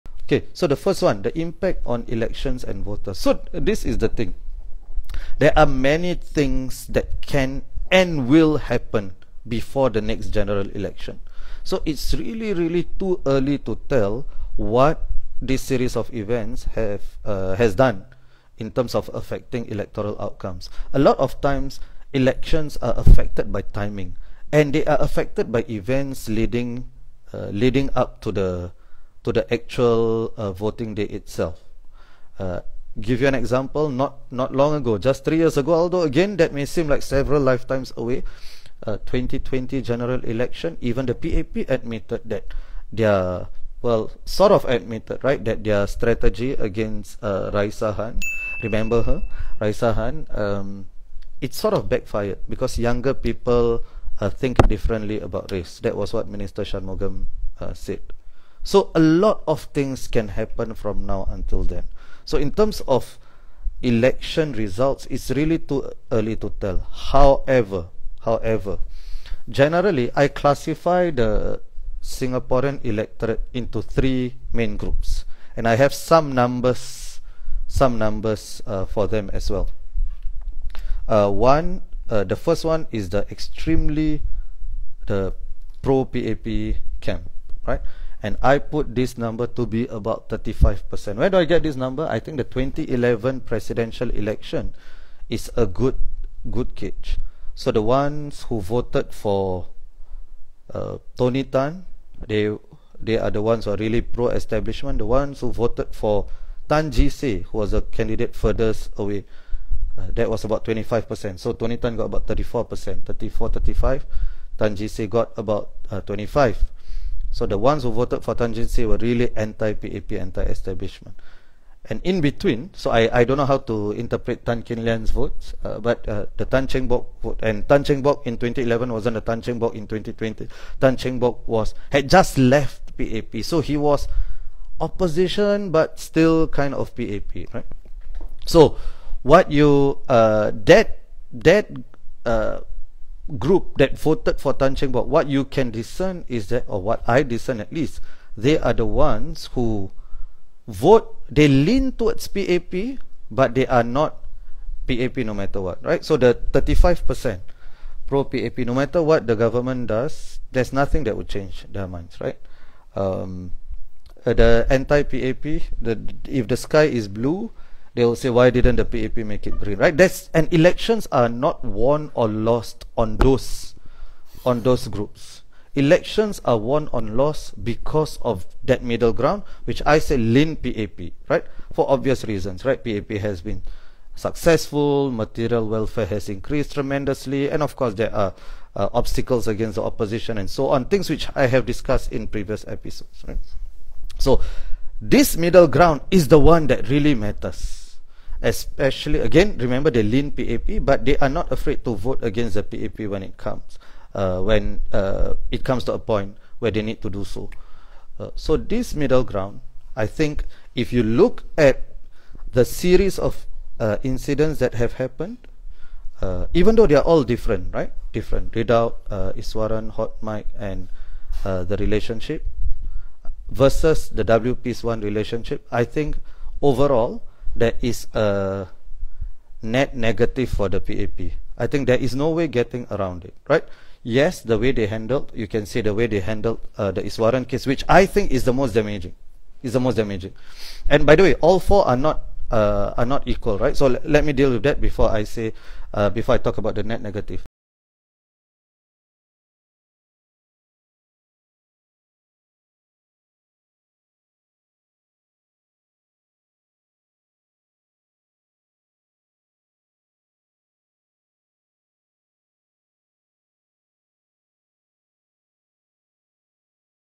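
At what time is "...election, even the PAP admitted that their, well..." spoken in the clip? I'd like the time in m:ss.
0:40.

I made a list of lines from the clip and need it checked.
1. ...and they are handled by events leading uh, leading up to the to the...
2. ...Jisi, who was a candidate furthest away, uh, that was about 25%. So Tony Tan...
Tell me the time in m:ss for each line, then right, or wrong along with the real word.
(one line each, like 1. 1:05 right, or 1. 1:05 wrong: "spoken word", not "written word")
1. 0:24 wrong: "affected", not "handled"
2. 1:46 right.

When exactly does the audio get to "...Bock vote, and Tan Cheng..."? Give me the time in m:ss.
2:06.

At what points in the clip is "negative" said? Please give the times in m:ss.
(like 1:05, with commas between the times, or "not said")
3:49, 4:07.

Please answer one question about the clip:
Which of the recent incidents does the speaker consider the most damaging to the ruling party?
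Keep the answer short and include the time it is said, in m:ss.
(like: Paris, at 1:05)
Iswaran case, at 3:57.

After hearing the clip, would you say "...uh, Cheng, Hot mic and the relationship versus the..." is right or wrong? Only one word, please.
wrong.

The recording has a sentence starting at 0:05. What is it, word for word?
There are many things that can and will happen before the next general election.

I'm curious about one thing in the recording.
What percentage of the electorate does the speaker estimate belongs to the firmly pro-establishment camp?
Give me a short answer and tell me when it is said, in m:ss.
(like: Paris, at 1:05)
35%, at 1:29.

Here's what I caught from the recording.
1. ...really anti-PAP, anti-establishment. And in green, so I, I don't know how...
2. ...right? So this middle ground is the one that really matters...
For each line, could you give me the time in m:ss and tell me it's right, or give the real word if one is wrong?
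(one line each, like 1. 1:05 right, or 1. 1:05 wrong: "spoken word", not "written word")
1. 1:58 wrong: "between", not "green"
2. 3:13 right.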